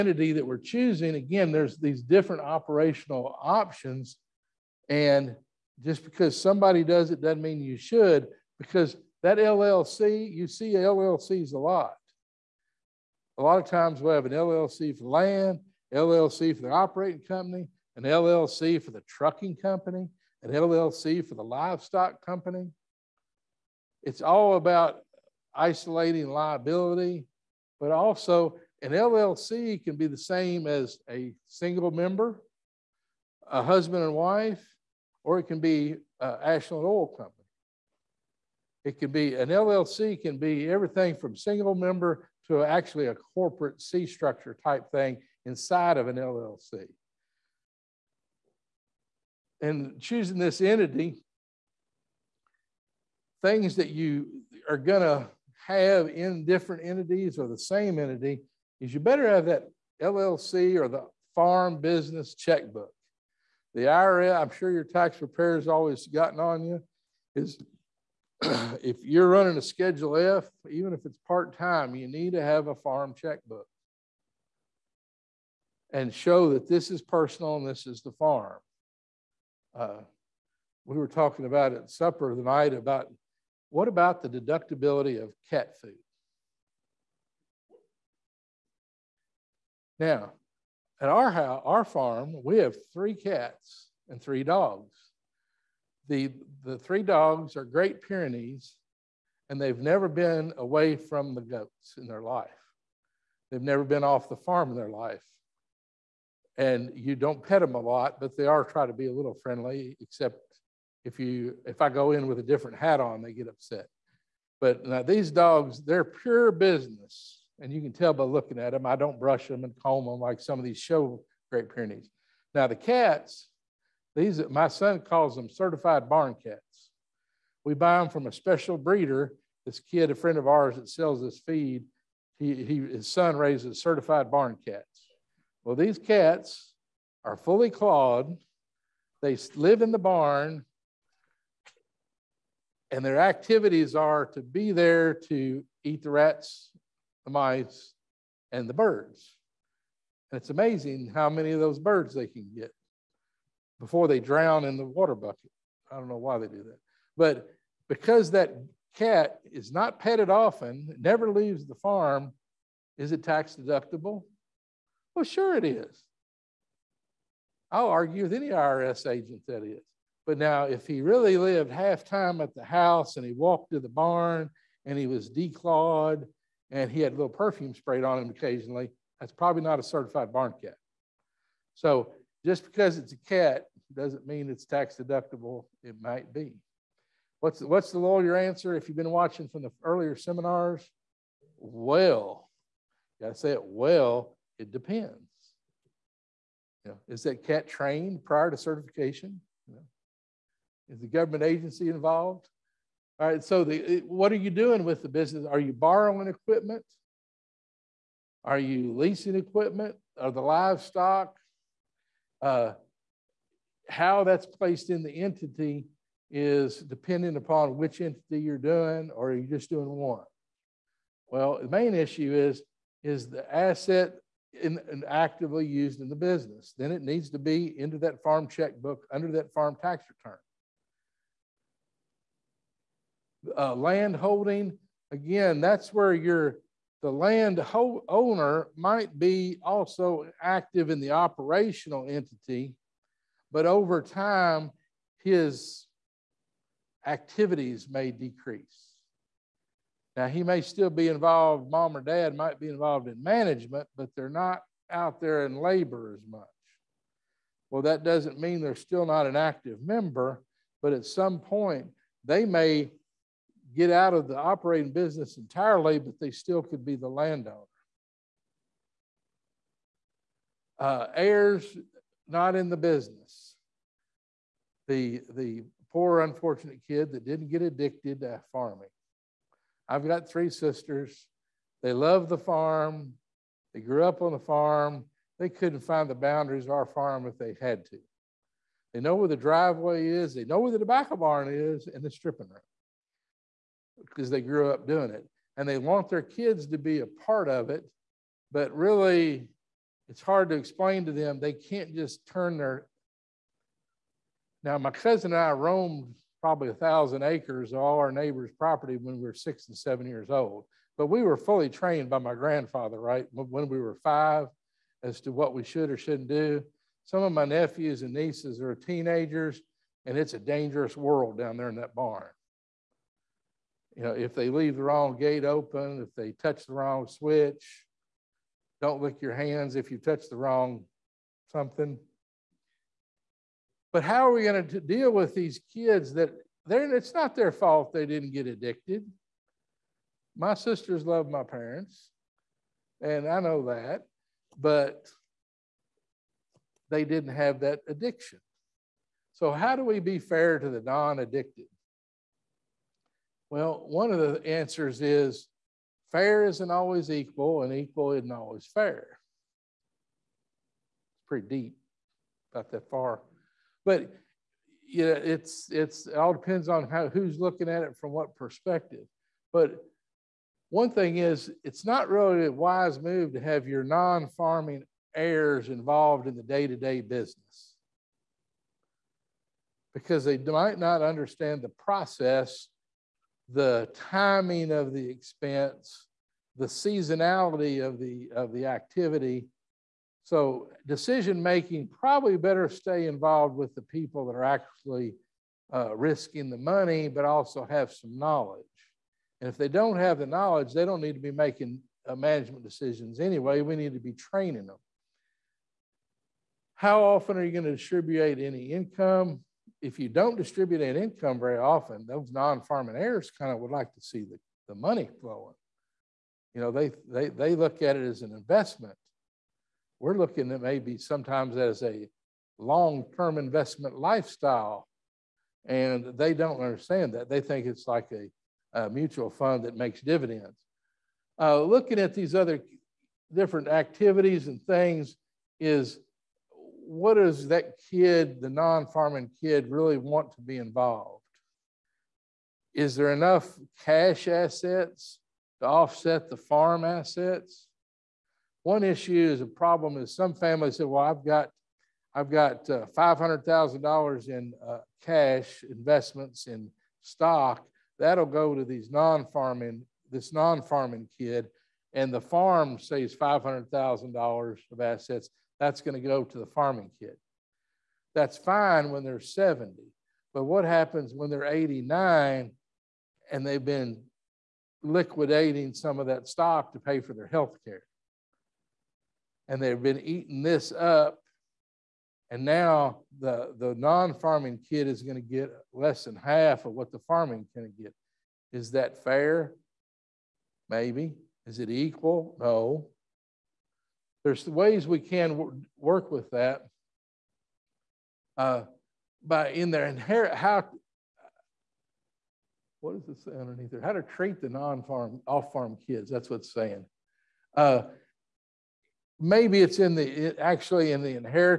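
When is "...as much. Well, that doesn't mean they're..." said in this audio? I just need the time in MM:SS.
04:16.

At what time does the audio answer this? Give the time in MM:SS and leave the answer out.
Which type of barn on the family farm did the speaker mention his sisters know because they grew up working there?
04:50.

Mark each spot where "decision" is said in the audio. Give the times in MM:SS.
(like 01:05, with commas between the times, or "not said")
06:30, 06:42.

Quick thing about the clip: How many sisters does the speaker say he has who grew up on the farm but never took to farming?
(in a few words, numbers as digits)
3.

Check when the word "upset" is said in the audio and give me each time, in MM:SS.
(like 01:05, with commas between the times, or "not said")
01:53.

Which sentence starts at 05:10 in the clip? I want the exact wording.
But we were fully trained by my grandfather, right, when we were five, as to what we should or shouldn't do.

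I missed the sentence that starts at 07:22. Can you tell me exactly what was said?
Is there enough cash assets to offset the farm assets?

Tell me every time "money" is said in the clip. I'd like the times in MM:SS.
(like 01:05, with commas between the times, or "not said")
06:36, 06:54.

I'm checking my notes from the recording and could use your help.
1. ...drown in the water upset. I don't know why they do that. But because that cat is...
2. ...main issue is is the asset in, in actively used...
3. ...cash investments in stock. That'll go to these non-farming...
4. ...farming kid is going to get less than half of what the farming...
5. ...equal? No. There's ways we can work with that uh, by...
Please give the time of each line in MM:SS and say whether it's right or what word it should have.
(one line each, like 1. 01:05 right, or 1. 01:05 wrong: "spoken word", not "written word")
1. 02:34 wrong: "bucket", not "upset"
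2. 03:41 right
3. 07:35 right
4. 08:04 right
5. 08:11 right.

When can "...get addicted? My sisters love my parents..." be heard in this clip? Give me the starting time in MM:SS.
05:38.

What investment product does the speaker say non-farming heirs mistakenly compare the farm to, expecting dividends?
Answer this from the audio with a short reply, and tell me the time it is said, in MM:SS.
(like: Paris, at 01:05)
mutual fund, at 07:08.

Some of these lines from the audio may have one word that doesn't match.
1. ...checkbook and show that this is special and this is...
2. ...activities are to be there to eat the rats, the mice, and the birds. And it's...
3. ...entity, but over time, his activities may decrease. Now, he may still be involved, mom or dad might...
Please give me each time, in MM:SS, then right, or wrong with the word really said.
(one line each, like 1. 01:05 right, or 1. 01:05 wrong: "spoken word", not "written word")
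1. 01:13 wrong: "personal", not "special"
2. 02:23 right
3. 04:02 right.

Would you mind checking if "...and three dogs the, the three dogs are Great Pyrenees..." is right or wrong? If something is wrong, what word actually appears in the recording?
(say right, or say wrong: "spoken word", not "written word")
right.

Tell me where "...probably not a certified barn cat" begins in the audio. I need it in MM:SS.
02:59.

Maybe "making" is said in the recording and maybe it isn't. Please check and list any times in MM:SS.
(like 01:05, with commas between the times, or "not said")
06:31, 06:41.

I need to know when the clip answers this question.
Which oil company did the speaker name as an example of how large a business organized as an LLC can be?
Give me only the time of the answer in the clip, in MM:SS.
00:36.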